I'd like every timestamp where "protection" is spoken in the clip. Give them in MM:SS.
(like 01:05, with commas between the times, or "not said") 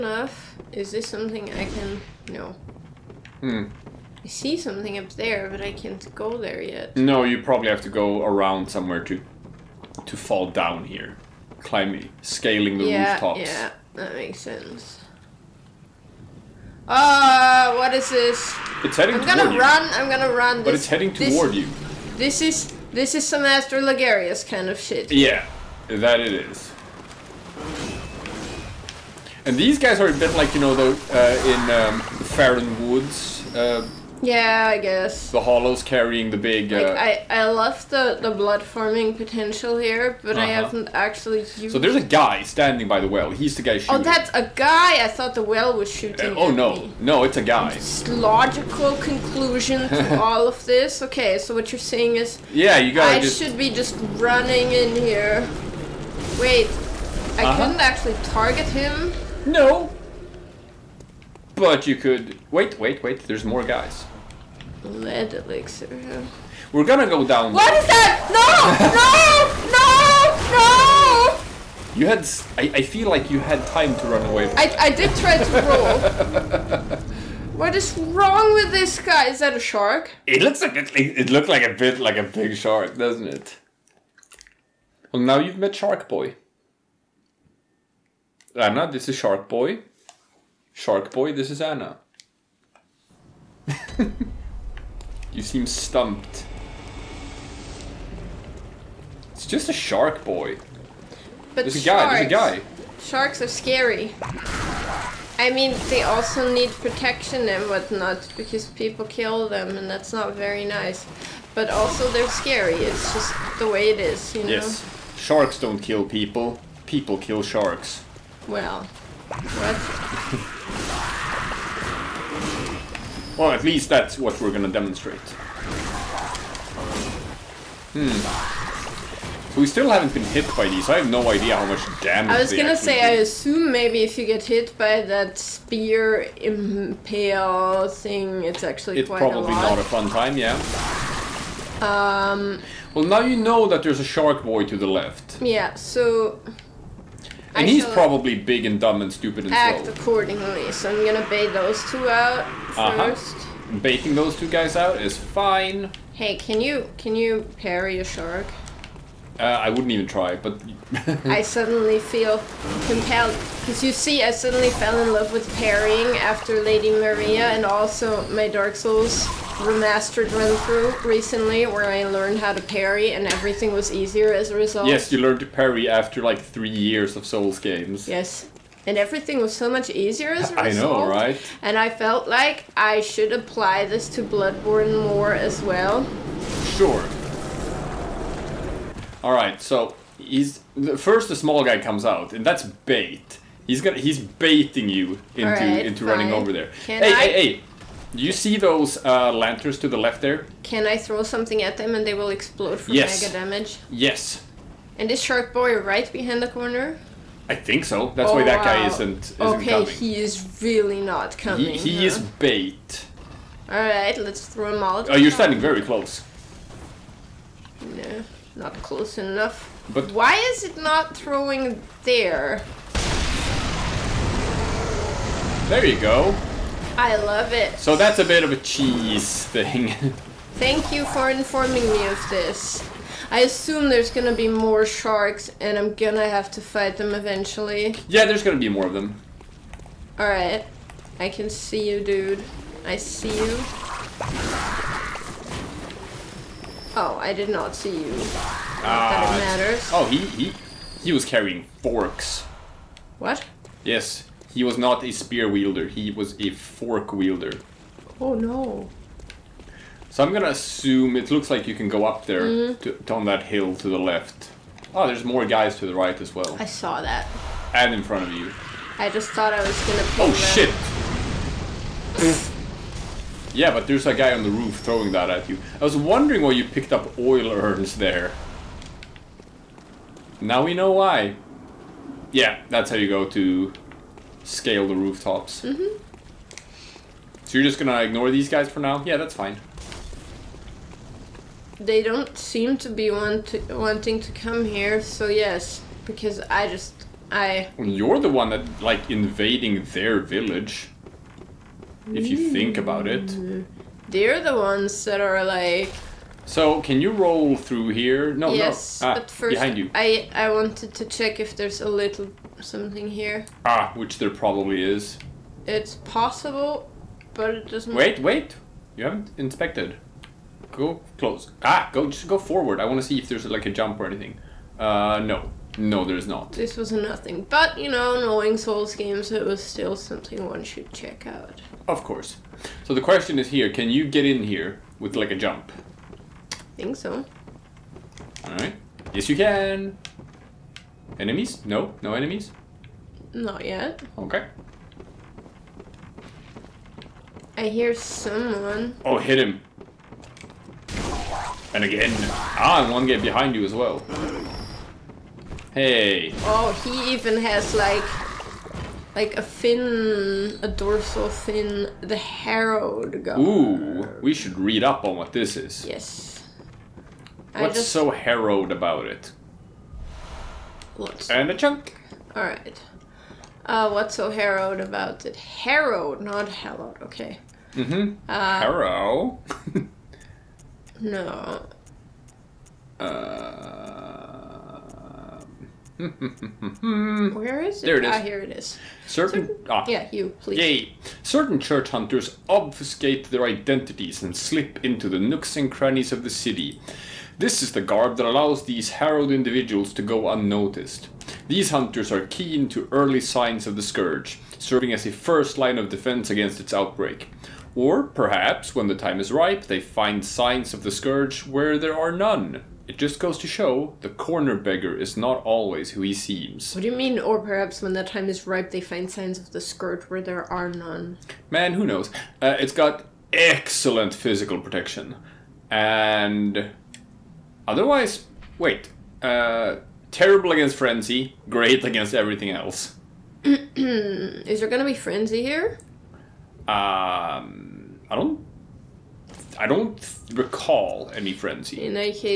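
01:46, 07:04.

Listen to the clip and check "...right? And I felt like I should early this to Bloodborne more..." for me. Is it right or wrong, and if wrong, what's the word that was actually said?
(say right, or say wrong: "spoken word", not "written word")
wrong: "apply", not "early".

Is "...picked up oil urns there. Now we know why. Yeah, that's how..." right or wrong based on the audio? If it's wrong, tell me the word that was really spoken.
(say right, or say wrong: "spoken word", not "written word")
right.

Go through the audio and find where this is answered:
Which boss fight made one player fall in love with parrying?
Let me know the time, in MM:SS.
02:46.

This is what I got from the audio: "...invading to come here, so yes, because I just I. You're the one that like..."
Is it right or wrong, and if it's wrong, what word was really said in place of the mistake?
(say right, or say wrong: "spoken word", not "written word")
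wrong: "wanting", not "invading".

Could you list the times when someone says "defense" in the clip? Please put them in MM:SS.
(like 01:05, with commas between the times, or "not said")
06:45.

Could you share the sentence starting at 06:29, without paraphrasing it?
Certain, Certain ah, yeah, you please.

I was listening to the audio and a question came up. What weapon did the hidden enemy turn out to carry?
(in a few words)
Forks.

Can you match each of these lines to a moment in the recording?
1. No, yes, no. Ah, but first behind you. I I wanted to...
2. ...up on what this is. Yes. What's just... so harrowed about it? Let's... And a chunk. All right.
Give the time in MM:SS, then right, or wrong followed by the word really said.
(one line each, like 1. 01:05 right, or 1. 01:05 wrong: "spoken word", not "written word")
1. 05:08 right
2. 06:04 right.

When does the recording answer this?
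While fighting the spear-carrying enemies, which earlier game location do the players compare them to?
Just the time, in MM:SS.
00:32.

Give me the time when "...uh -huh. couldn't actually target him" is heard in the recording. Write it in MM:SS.
00:56.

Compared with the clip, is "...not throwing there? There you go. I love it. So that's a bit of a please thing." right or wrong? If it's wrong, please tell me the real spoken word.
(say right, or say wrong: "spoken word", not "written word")
wrong: "cheese", not "please".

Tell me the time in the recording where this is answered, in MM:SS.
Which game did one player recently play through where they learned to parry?
02:48.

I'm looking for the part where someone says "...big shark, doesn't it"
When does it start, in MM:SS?
01:22.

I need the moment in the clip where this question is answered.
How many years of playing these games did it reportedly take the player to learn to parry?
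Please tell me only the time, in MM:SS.
02:56.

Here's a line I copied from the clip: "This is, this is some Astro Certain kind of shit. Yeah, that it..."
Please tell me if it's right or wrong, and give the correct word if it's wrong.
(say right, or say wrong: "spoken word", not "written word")
wrong: "Lagarius", not "Certain".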